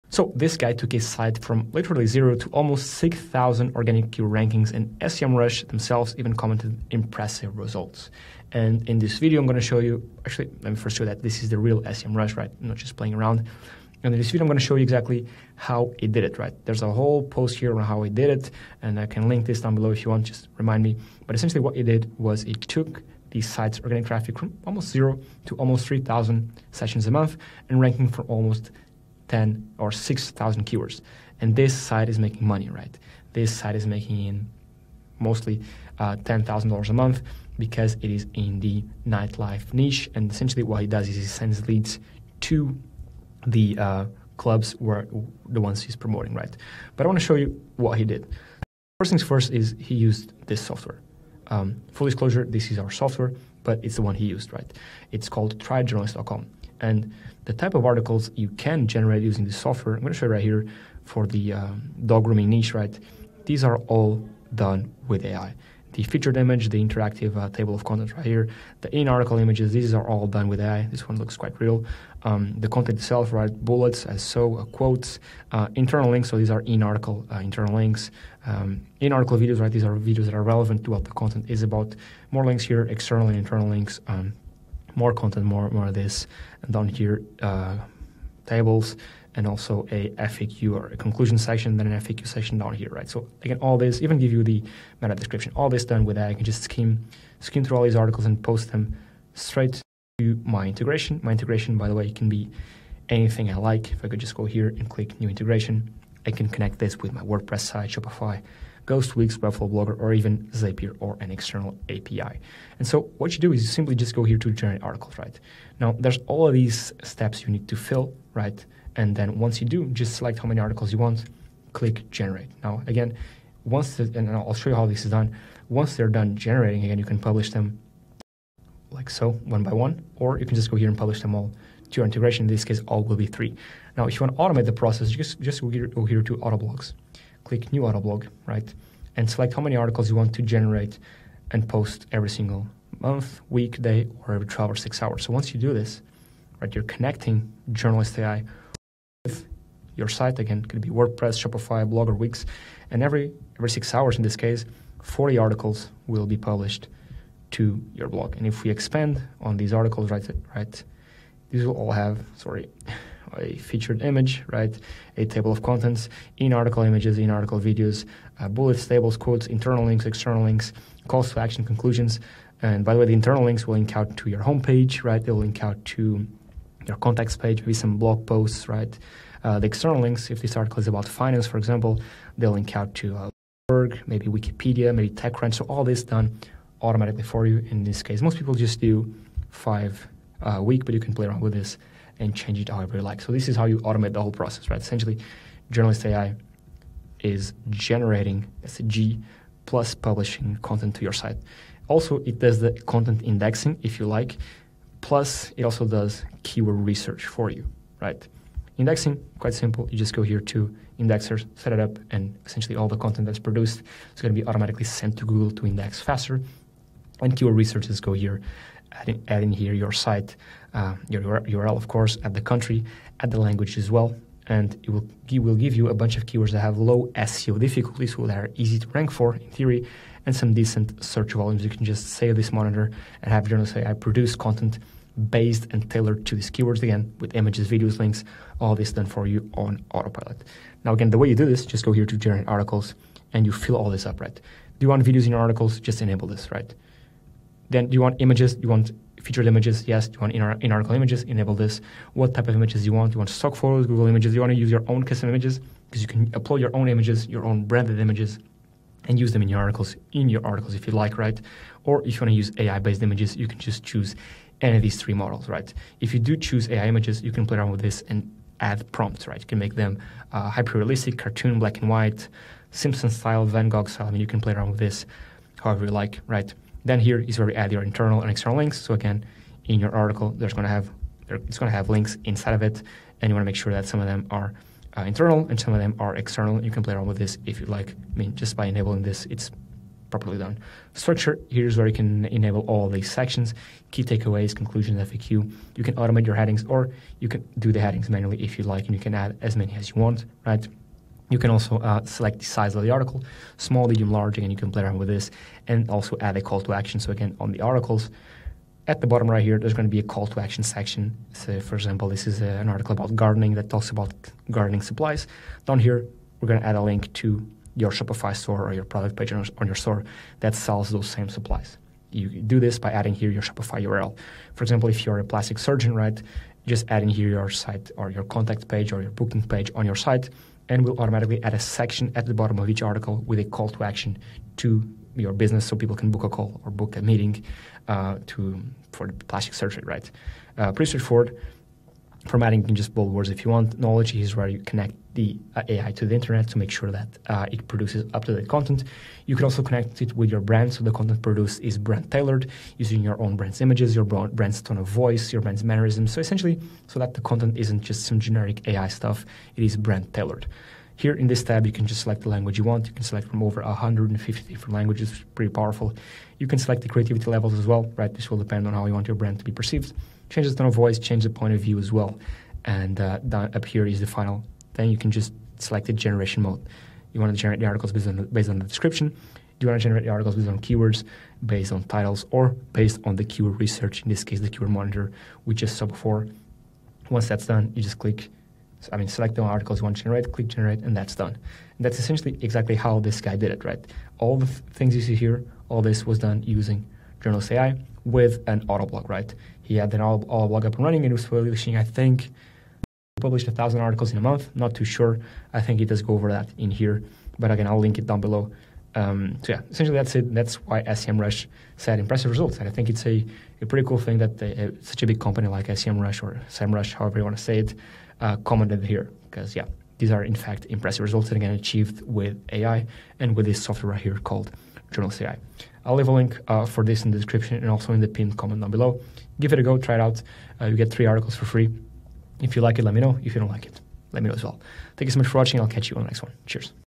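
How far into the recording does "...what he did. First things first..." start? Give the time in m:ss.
0:47.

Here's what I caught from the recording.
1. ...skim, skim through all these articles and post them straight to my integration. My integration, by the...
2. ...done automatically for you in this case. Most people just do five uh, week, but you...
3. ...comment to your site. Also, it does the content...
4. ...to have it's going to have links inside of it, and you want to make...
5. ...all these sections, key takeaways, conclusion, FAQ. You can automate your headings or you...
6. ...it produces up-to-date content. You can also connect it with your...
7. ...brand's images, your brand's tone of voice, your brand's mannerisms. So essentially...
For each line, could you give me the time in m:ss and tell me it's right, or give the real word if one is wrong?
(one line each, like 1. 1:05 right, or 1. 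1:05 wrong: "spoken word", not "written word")
1. 1:36 right
2. 3:06 right
3. 3:20 wrong: "content", not "comment"
4. 4:40 right
5. 4:52 right
6. 5:47 right
7. 5:53 right.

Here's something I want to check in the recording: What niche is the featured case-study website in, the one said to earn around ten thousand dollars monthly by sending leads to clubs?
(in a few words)
nightlife.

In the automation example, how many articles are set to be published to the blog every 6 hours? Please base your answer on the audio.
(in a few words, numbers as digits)
40.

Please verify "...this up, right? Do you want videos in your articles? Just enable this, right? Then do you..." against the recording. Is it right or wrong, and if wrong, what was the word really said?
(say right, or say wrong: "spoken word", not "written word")
right.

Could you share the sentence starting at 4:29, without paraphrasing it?
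You can make them uh, hyper-realistic, cartoon, black and white, Simpson style, Van Gogh style.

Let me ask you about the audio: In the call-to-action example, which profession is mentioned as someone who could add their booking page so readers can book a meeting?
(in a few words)
plastic surgeon.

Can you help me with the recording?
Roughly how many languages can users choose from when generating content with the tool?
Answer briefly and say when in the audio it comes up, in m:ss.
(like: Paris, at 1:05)
over 150, at 6:03.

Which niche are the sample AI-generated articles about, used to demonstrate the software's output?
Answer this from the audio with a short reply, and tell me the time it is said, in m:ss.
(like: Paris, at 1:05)
dog grooming, at 1:02.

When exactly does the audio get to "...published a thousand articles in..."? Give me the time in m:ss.
6:43.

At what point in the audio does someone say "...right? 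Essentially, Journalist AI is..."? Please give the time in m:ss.
3:14.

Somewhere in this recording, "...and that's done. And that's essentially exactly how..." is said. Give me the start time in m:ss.
6:30.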